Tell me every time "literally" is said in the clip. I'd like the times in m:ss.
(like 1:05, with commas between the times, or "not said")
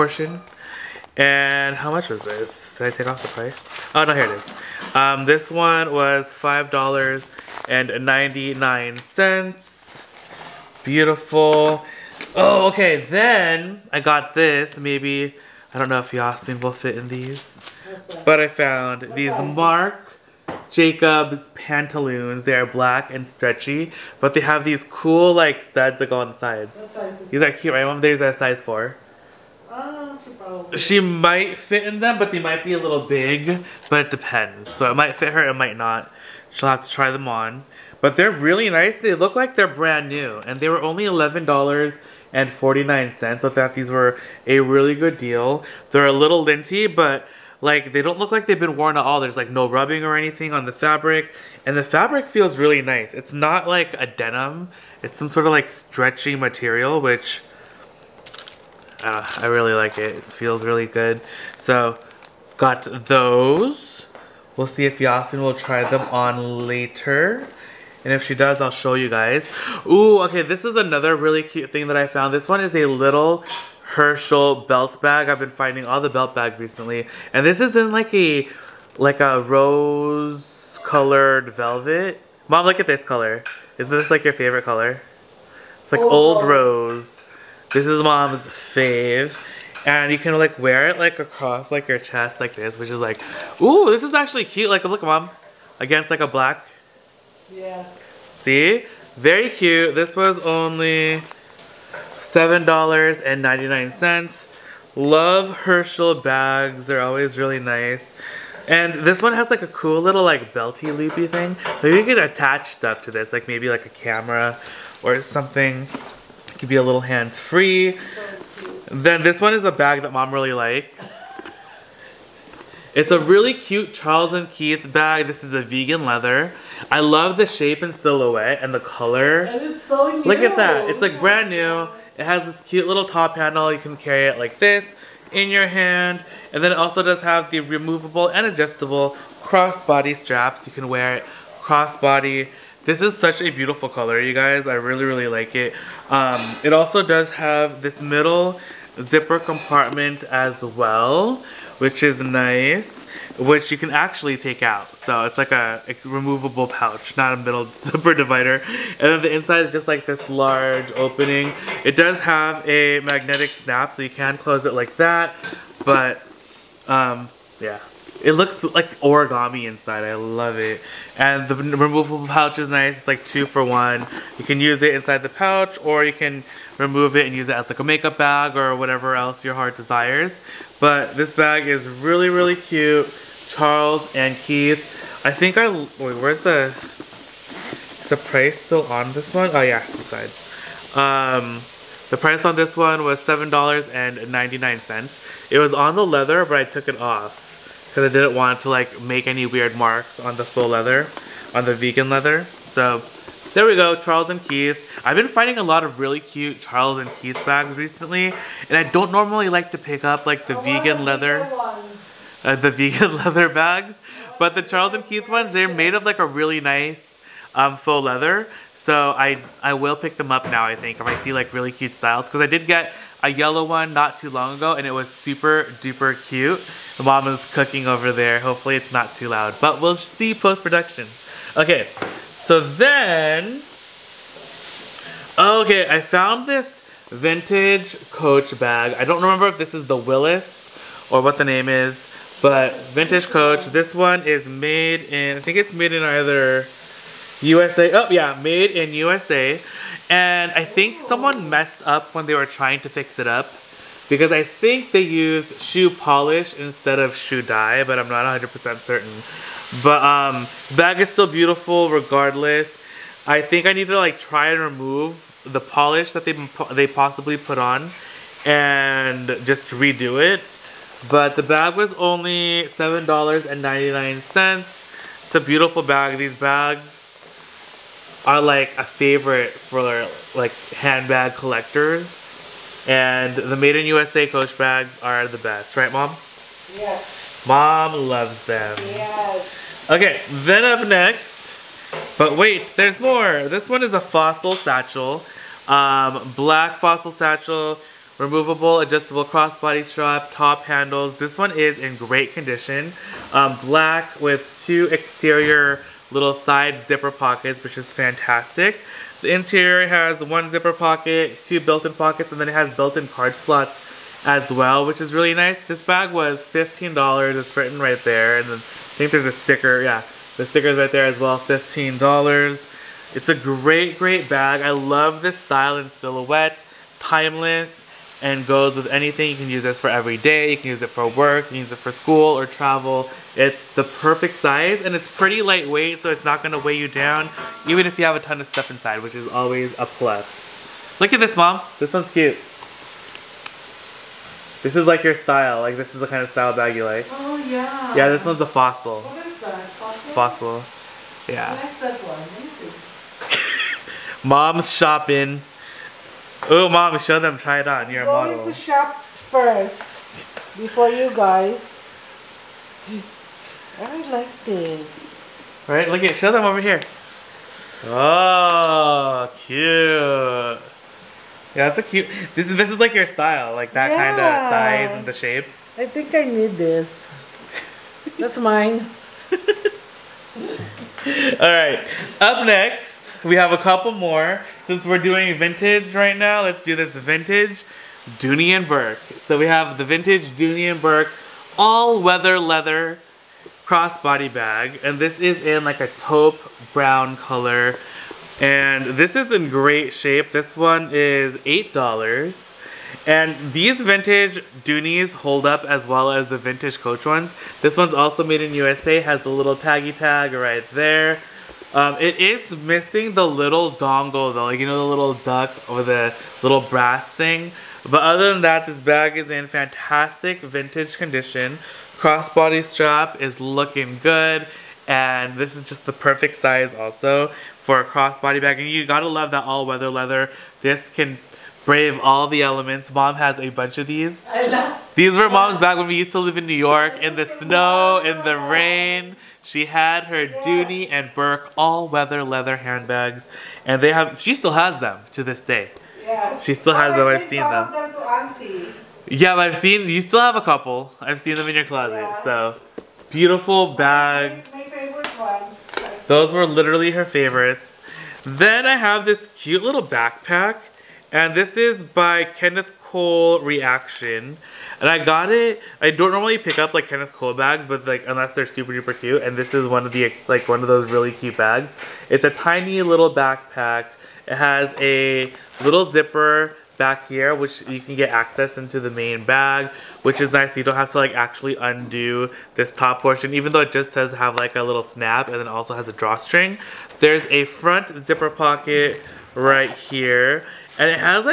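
7:36.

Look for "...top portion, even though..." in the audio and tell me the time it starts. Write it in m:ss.
8:02.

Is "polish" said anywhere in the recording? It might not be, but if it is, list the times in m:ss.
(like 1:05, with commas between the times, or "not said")
4:15, 4:25.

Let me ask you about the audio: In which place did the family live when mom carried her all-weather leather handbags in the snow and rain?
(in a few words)
New York.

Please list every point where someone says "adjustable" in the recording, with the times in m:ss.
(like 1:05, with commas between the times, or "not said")
2:18, 4:58.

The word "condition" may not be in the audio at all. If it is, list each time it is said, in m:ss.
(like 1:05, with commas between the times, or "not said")
5:02, 7:00.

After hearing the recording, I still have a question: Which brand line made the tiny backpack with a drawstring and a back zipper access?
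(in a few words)
Kenneth Cole Reaction.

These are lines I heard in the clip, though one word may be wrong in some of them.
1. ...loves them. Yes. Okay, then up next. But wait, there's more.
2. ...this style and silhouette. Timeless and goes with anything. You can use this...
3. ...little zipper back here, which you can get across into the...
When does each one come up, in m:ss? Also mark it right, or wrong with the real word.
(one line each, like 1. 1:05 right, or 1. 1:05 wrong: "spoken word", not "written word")
1. 4:48 right
2. 5:25 right
3. 7:55 wrong: "access", not "across".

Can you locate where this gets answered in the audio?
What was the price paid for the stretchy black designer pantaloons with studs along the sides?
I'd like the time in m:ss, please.
0:41.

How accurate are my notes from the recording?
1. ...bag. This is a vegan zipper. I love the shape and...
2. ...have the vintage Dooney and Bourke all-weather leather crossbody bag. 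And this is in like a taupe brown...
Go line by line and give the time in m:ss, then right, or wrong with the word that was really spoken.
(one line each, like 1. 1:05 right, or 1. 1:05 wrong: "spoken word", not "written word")
1. 2:04 wrong: "leather", not "zipper"
2. 6:29 right.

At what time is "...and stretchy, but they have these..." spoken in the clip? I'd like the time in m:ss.
0:23.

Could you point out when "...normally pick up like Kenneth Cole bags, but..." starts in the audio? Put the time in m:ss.
7:46.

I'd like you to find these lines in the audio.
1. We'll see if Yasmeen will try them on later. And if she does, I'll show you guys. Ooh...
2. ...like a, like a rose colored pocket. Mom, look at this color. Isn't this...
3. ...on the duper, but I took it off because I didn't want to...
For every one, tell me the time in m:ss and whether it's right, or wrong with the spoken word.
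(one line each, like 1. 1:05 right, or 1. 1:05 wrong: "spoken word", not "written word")
1. 1:04 right
2. 1:17 wrong: "velvet", not "pocket"
3. 3:15 wrong: "leather", not "duper".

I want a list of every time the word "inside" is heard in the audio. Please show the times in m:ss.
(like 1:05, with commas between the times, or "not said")
2:39, 2:49, 2:54, 3:09, 5:38.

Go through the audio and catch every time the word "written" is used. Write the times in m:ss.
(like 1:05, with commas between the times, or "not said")
5:17.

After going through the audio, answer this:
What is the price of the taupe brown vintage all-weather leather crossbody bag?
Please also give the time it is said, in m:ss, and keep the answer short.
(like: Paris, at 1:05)
$8, at 6:41.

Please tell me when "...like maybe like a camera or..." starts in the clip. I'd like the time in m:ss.
1:53.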